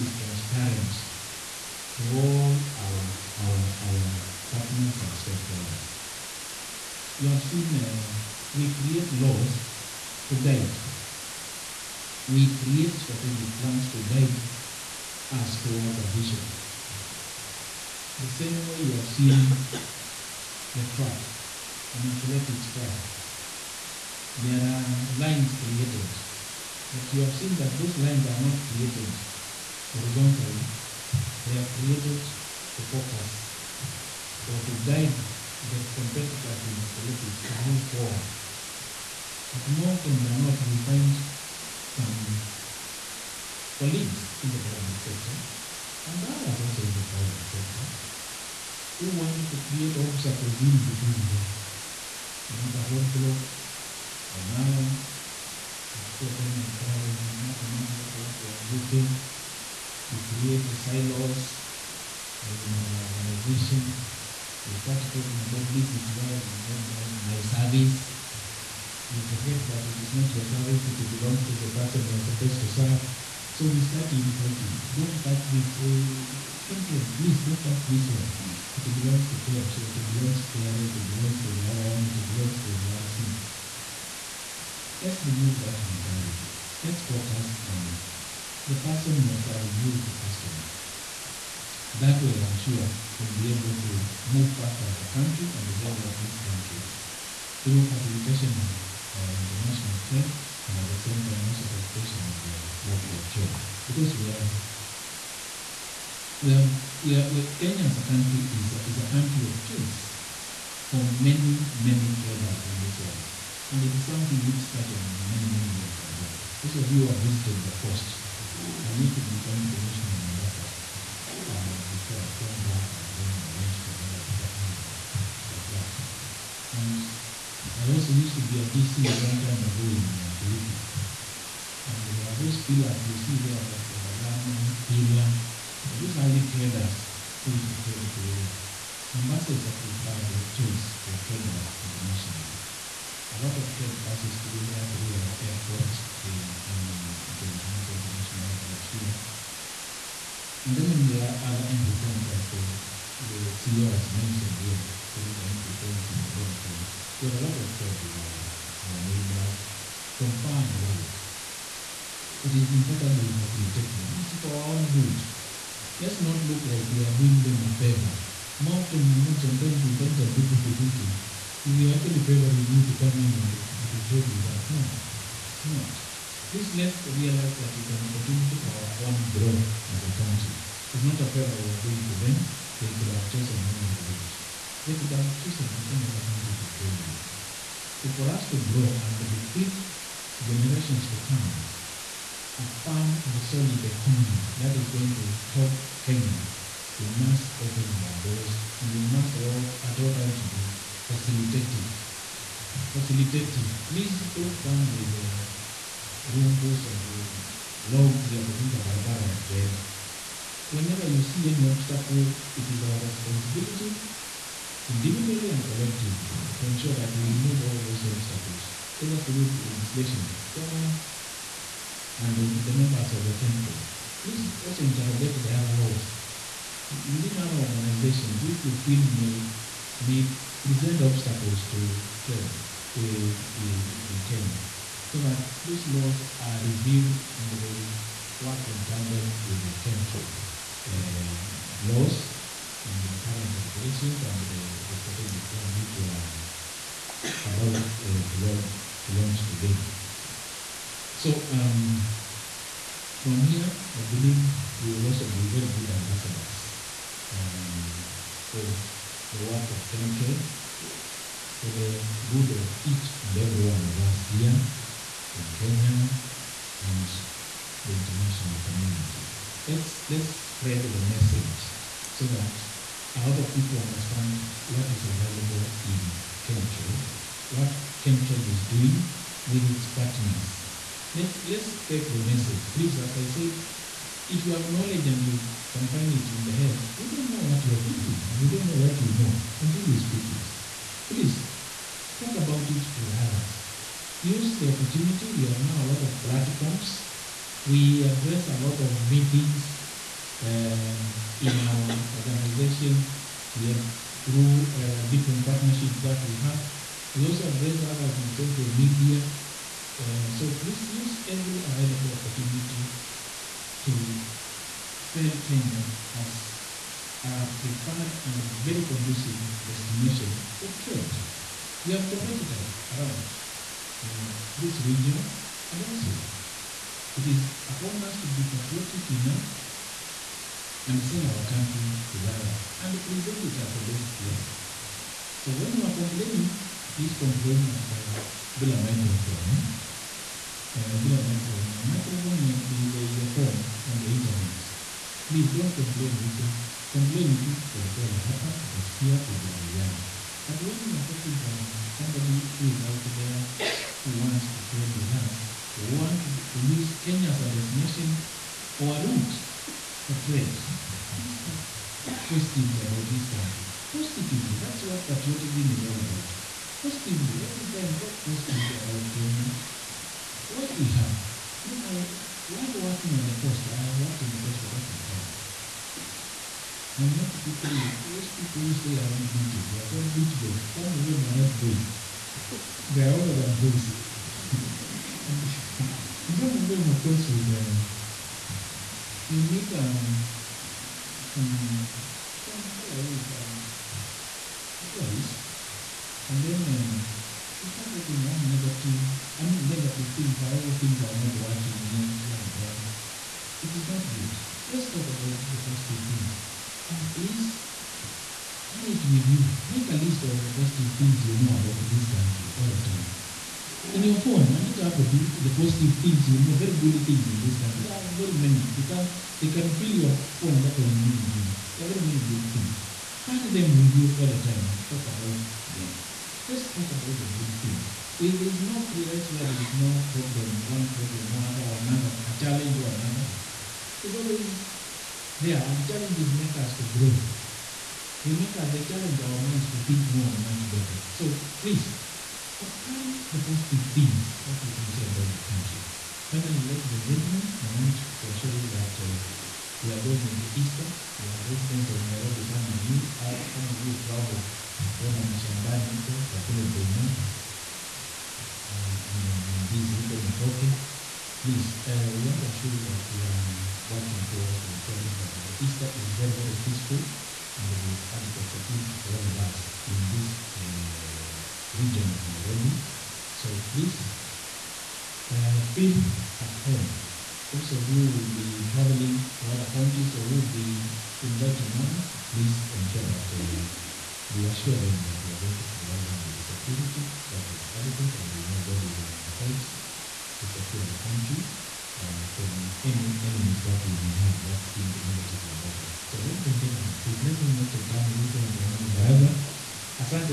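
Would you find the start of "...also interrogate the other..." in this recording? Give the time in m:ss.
3:44.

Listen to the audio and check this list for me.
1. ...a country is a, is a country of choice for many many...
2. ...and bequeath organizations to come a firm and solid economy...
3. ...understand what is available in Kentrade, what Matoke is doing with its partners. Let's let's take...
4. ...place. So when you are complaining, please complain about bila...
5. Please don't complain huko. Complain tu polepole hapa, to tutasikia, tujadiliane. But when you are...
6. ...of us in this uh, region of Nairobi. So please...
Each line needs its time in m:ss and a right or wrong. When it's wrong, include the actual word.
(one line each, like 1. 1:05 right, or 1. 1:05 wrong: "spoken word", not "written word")
1. 1:48 right
2. 3:09 wrong: "generations", not "organizations"
3. 4:33 wrong: "Kentrade", not "Matoke"
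4. 5:34 right
5. 5:45 right
6. 7:49 right.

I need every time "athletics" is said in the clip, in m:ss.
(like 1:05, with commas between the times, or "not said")
0:22, 0:36.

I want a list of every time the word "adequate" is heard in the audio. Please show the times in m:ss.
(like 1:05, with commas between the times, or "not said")
7:48, 8:07.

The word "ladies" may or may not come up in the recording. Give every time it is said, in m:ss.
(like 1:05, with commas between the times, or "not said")
7:26, 8:16.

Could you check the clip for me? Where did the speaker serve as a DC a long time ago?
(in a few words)
Kilifi.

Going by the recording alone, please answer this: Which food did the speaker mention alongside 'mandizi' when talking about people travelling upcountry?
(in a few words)
Matoke.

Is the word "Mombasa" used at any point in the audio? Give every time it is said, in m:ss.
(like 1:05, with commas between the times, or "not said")
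2:00, 2:19.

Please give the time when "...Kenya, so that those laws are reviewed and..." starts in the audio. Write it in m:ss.
3:54.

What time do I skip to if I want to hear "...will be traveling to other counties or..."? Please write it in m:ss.
7:58.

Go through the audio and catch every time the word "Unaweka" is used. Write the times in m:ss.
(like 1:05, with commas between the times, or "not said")
0:52.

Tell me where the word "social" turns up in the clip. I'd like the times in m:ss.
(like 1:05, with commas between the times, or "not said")
5:08.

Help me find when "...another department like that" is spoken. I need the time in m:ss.
2:03.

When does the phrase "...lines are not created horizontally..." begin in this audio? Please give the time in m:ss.
0:27.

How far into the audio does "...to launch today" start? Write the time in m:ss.
4:09.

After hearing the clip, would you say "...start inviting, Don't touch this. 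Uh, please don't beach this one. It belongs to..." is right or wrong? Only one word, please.
wrong.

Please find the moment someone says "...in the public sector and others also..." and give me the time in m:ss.
0:44.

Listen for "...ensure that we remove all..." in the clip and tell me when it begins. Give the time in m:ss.
3:36.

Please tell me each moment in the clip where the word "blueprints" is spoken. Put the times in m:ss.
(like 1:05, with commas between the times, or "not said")
not said.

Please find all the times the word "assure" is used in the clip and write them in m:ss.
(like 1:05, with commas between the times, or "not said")
7:28, 7:42, 8:04.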